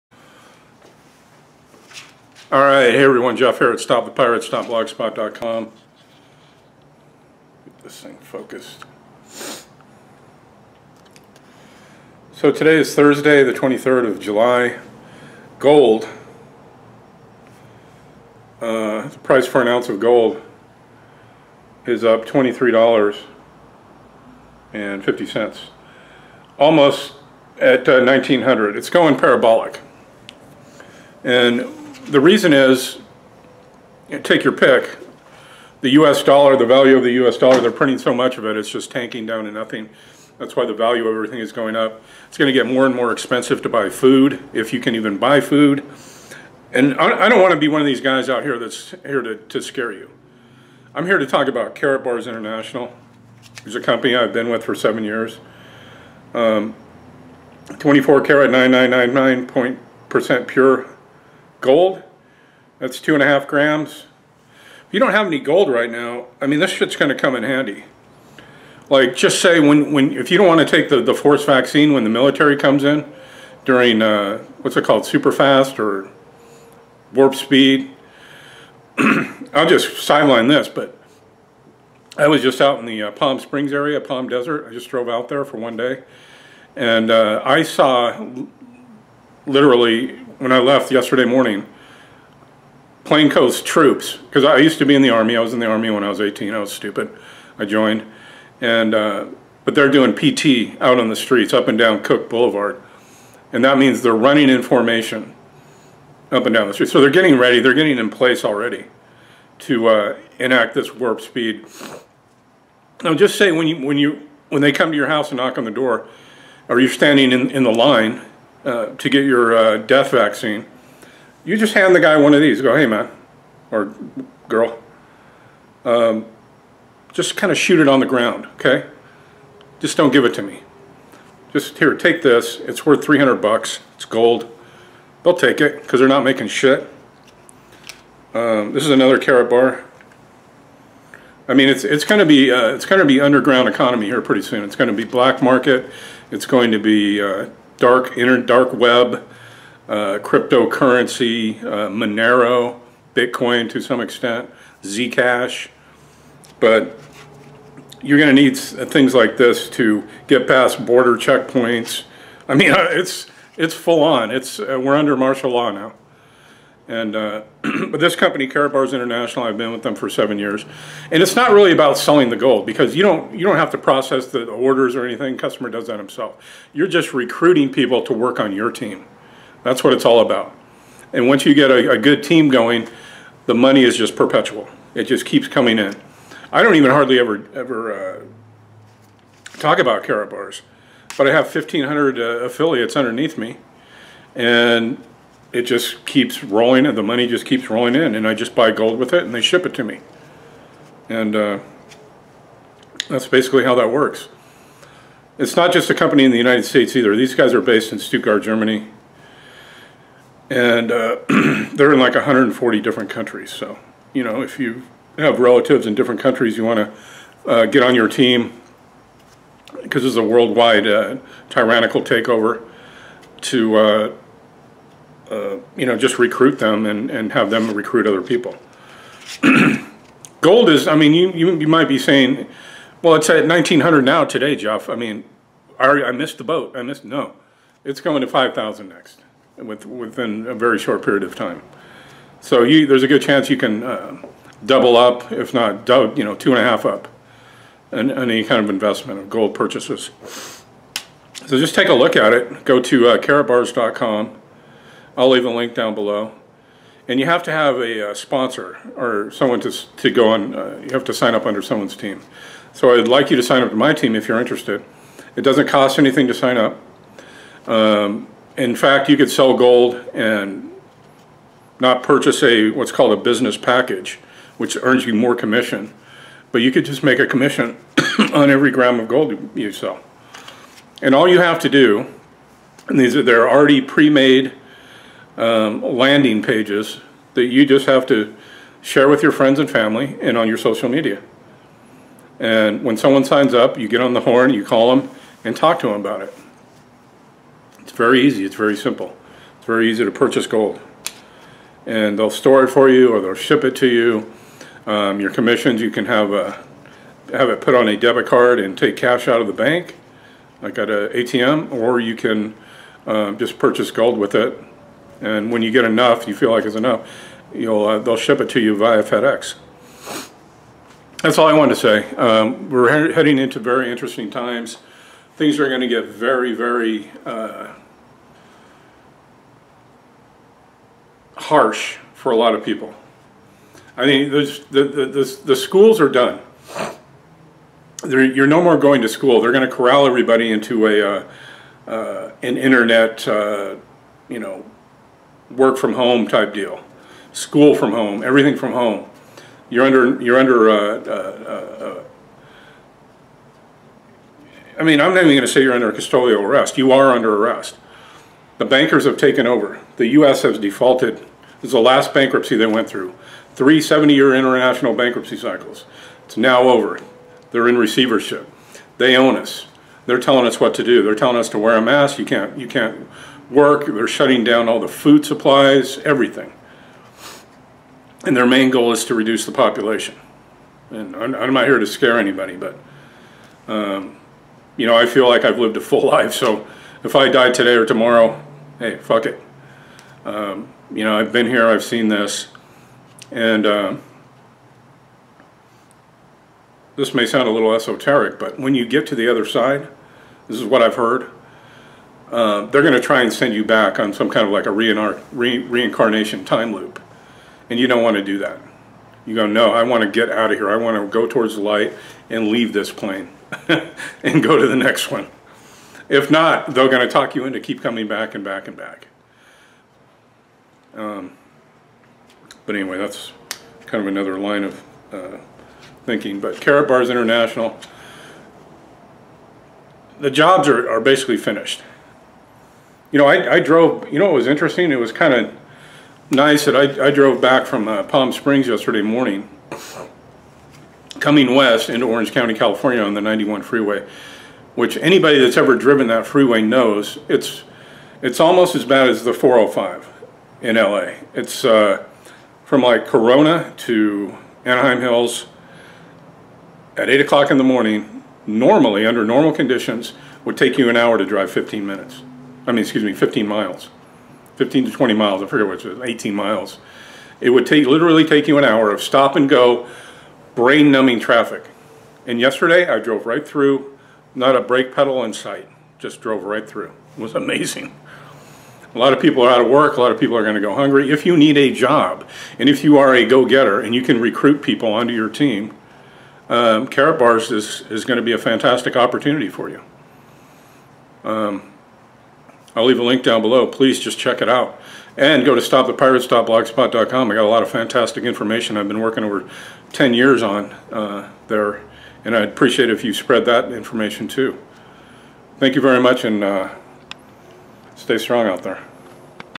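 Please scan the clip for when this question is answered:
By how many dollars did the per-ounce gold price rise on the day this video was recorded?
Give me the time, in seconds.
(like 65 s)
22 s.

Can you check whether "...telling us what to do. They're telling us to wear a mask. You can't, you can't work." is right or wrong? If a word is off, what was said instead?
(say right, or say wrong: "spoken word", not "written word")
right.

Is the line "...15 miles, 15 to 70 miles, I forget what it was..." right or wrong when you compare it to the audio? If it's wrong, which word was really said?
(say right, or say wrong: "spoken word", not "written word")
wrong: "20", not "70".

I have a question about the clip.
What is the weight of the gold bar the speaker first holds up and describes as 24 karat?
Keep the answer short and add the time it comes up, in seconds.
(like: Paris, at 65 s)
2.5 grams, at 62 s.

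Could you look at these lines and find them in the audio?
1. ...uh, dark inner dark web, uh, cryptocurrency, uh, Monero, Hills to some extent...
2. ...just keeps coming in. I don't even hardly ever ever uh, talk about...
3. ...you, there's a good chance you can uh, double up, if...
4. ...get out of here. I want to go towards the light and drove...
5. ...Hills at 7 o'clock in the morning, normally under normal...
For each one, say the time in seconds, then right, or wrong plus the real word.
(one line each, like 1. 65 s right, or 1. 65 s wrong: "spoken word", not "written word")
1. 147 s wrong: "Bitcoin", not "Hills"
2. 185 s right
3. 242 s right
4. 410 s wrong: "leave", not "drove"
5. 455 s wrong: "8", not "7".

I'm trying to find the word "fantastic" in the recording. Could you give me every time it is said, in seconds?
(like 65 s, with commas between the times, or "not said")
488 s, 497 s.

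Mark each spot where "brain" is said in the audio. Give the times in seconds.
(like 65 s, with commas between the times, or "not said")
470 s.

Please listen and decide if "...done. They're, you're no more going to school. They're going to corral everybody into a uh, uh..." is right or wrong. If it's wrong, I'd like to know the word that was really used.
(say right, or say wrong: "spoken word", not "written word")
right.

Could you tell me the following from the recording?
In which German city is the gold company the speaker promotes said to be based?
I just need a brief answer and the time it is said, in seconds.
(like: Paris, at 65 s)
Stuttgart, at 207 s.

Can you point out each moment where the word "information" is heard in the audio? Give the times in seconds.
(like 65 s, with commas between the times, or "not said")
498 s, 503 s.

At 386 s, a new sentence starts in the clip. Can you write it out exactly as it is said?
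So if I die today or tomorrow, hey, fuck it.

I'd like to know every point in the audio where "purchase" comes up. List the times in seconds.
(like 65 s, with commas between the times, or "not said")
249 s, 272 s, 300 s, 313 s.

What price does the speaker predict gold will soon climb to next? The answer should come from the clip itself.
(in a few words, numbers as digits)
5,000.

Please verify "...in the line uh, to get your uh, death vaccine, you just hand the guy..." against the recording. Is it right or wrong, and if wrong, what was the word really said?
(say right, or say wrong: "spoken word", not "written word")
right.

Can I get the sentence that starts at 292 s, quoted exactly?
And when someone signs up, you get on the horn, you call them, and talk to them about it.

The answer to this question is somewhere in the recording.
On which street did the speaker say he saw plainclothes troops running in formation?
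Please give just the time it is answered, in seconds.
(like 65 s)
102 s.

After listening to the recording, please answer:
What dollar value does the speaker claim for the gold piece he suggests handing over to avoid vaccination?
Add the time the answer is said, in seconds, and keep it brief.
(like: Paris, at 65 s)
$300, at 133 s.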